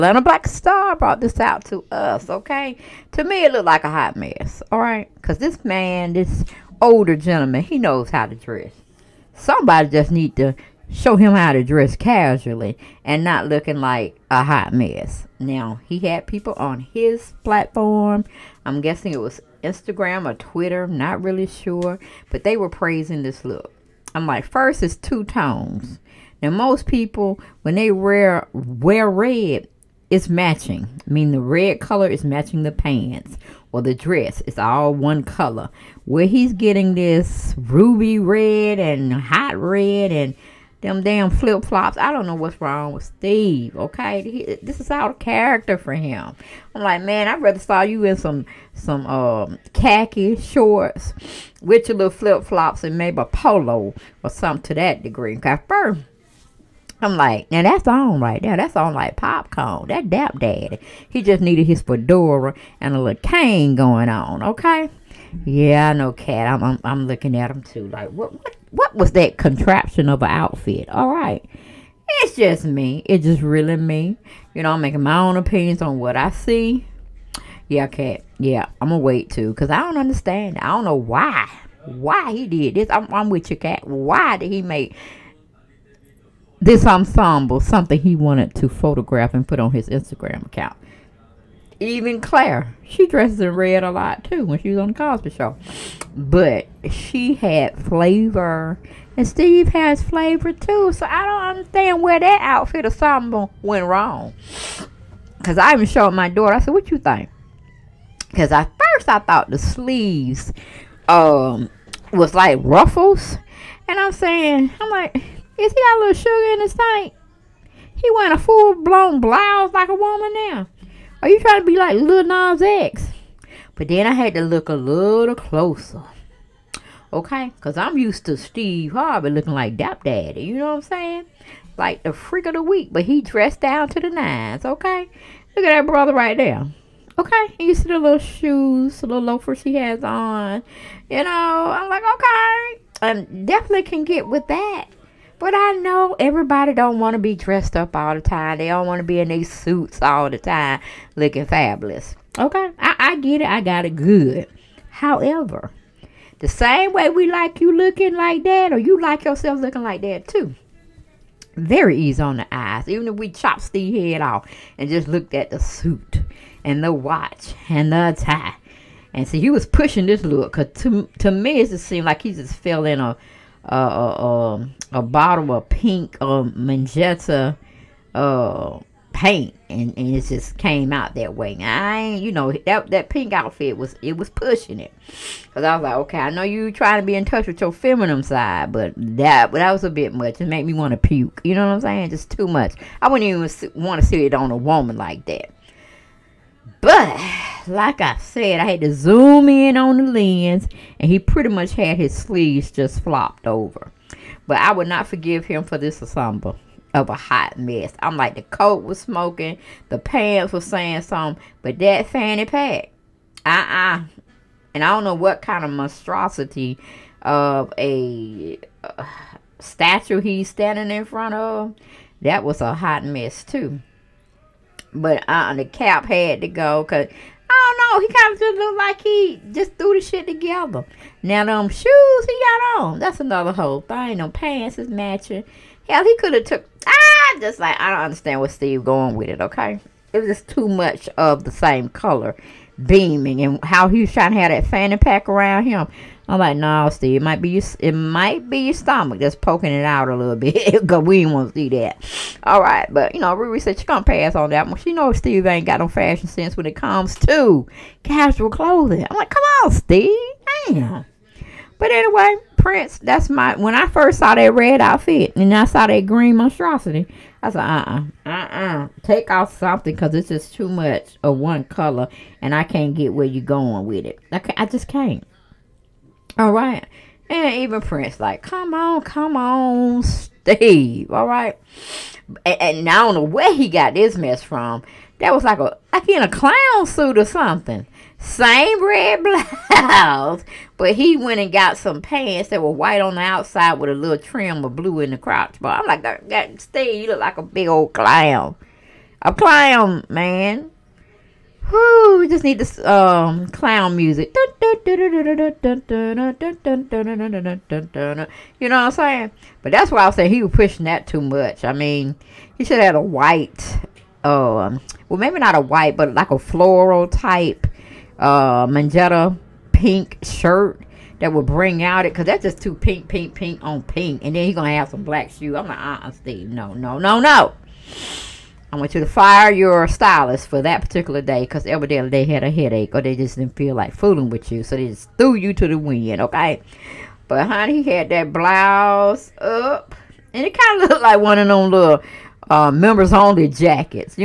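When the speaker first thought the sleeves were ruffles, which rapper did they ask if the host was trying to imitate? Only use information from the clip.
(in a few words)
Lil Nas X.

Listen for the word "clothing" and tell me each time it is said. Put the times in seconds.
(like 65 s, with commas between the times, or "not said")
258 s.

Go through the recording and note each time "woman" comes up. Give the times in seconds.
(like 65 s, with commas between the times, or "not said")
119 s, 194 s.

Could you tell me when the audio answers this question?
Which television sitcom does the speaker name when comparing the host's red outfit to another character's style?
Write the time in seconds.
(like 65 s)
94 s.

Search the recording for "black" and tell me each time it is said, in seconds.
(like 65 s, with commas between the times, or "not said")
0 s, 325 s.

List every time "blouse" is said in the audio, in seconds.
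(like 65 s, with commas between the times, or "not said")
119 s, 289 s, 338 s.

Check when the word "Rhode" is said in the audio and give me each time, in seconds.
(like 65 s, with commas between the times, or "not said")
not said.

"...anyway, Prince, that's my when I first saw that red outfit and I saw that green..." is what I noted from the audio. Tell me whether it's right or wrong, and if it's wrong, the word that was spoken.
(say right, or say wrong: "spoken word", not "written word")
right.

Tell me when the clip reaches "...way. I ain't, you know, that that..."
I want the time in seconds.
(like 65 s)
181 s.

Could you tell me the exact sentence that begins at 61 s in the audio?
He just needed his fedora and a little cane going on.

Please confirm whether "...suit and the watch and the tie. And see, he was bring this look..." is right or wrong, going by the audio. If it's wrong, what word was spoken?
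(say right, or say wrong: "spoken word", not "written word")
wrong: "pushing", not "bring".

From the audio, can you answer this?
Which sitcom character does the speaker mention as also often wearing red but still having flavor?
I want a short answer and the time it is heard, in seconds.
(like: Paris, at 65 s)
Claire, at 92 s.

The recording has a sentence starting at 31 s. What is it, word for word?
I mean, the red color is matching the pants or the dress.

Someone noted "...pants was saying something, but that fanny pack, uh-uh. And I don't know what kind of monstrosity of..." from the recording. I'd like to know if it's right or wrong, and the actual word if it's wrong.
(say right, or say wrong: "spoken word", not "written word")
right.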